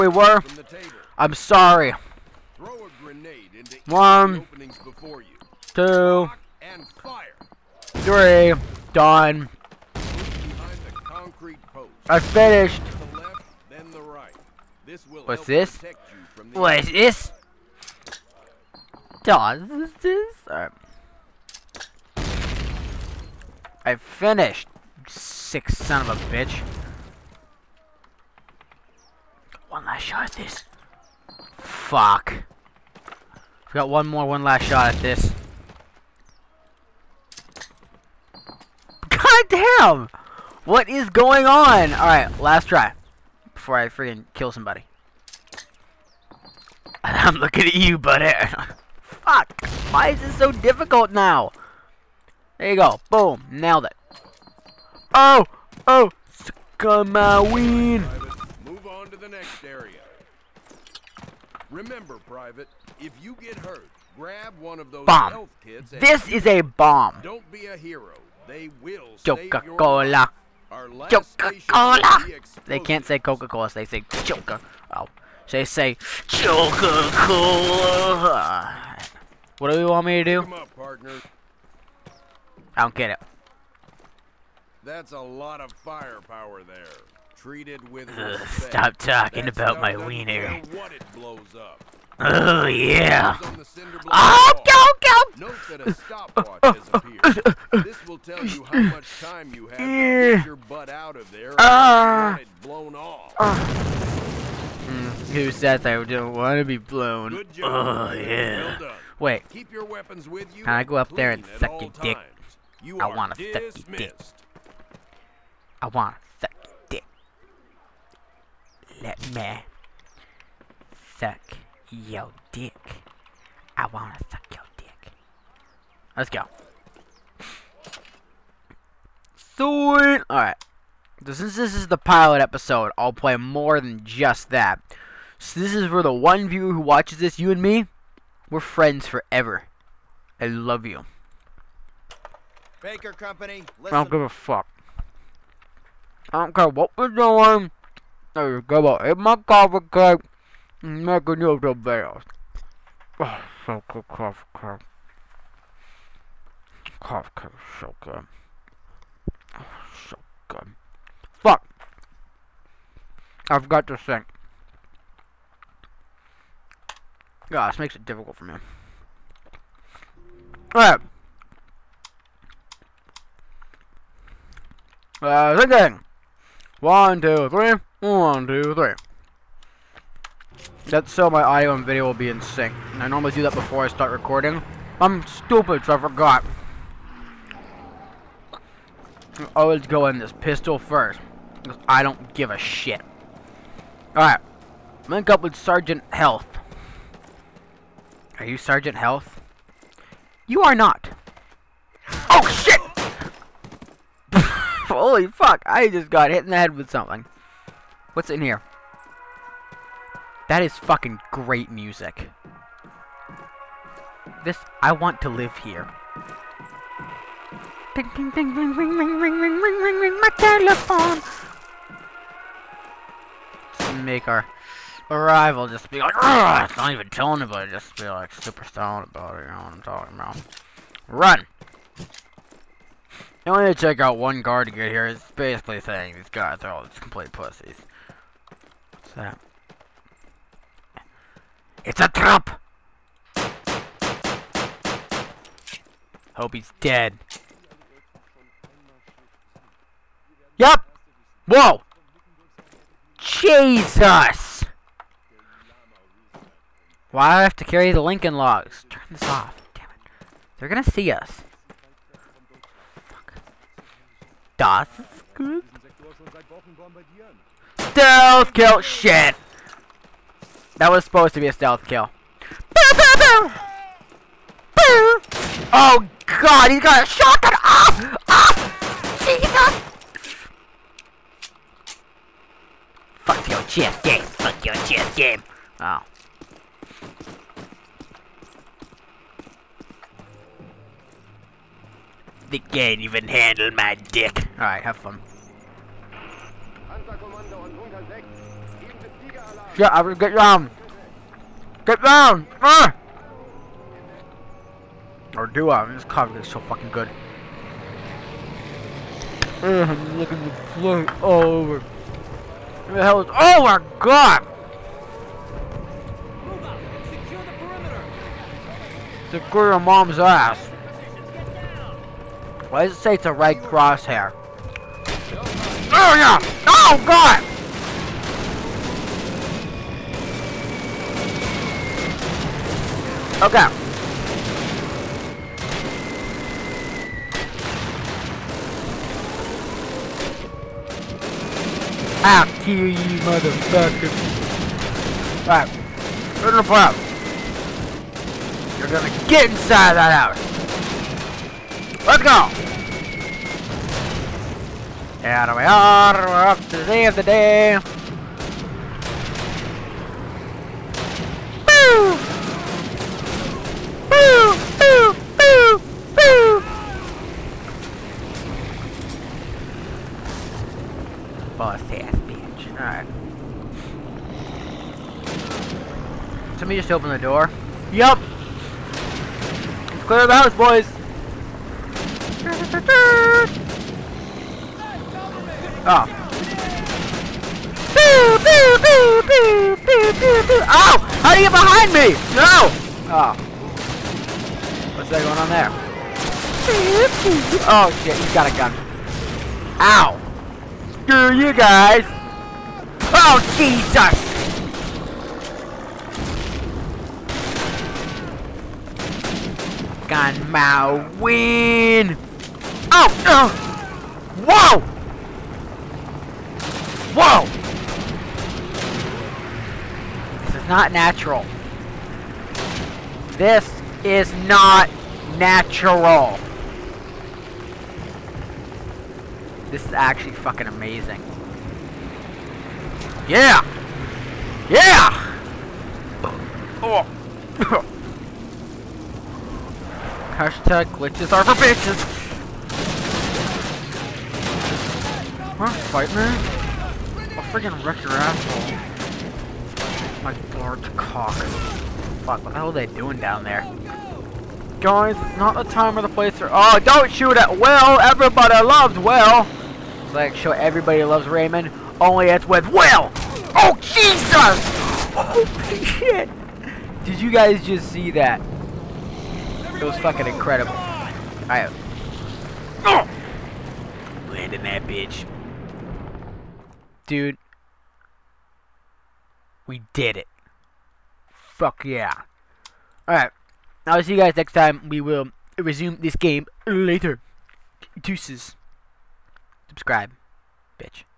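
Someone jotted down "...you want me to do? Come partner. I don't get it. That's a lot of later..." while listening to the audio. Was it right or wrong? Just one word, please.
wrong.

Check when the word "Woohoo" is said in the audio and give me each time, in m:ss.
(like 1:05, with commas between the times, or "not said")
not said.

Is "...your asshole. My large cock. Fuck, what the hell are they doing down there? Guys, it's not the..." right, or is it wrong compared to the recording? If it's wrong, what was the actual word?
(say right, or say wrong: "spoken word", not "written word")
right.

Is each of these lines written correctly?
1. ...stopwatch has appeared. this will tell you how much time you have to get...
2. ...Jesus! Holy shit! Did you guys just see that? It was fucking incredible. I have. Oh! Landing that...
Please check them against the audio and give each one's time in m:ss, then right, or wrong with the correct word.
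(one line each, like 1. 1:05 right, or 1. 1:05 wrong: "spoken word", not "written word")
1. 1:35 right
2. 7:43 right.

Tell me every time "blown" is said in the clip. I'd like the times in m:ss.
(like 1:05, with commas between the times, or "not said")
1:42, 1:46.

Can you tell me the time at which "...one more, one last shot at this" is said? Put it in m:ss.
0:33.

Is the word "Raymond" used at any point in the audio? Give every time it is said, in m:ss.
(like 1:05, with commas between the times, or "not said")
7:41.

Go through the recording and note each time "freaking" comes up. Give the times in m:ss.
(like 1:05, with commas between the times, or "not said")
0:43, 7:27.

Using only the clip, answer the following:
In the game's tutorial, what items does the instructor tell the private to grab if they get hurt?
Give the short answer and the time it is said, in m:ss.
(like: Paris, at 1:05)
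health kits, at 1:05.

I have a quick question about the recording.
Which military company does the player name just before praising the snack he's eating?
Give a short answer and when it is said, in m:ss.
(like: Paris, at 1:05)
Baker Company, at 2:22.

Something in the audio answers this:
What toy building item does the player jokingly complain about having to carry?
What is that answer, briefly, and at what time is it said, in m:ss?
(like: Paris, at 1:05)
Lincoln logs, at 4:18.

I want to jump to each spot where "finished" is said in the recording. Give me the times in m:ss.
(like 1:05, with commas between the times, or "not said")
0:12, 0:23.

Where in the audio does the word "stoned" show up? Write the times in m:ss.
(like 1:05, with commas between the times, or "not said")
3:48.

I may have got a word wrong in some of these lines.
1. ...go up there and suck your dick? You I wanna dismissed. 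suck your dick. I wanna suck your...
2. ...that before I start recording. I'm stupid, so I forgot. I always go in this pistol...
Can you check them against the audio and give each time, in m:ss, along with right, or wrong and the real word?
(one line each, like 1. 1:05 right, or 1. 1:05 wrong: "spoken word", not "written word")
1. 1:50 right
2. 3:03 right.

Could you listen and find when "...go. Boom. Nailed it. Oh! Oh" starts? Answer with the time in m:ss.
0:52.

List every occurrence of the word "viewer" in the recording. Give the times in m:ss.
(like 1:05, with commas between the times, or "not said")
2:16.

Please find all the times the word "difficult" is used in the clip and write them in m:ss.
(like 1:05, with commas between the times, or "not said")
0:50, 2:48.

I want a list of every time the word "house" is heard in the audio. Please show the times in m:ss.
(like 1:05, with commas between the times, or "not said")
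5:50, 6:20.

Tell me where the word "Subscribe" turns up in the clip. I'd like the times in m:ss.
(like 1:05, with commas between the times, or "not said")
8:09.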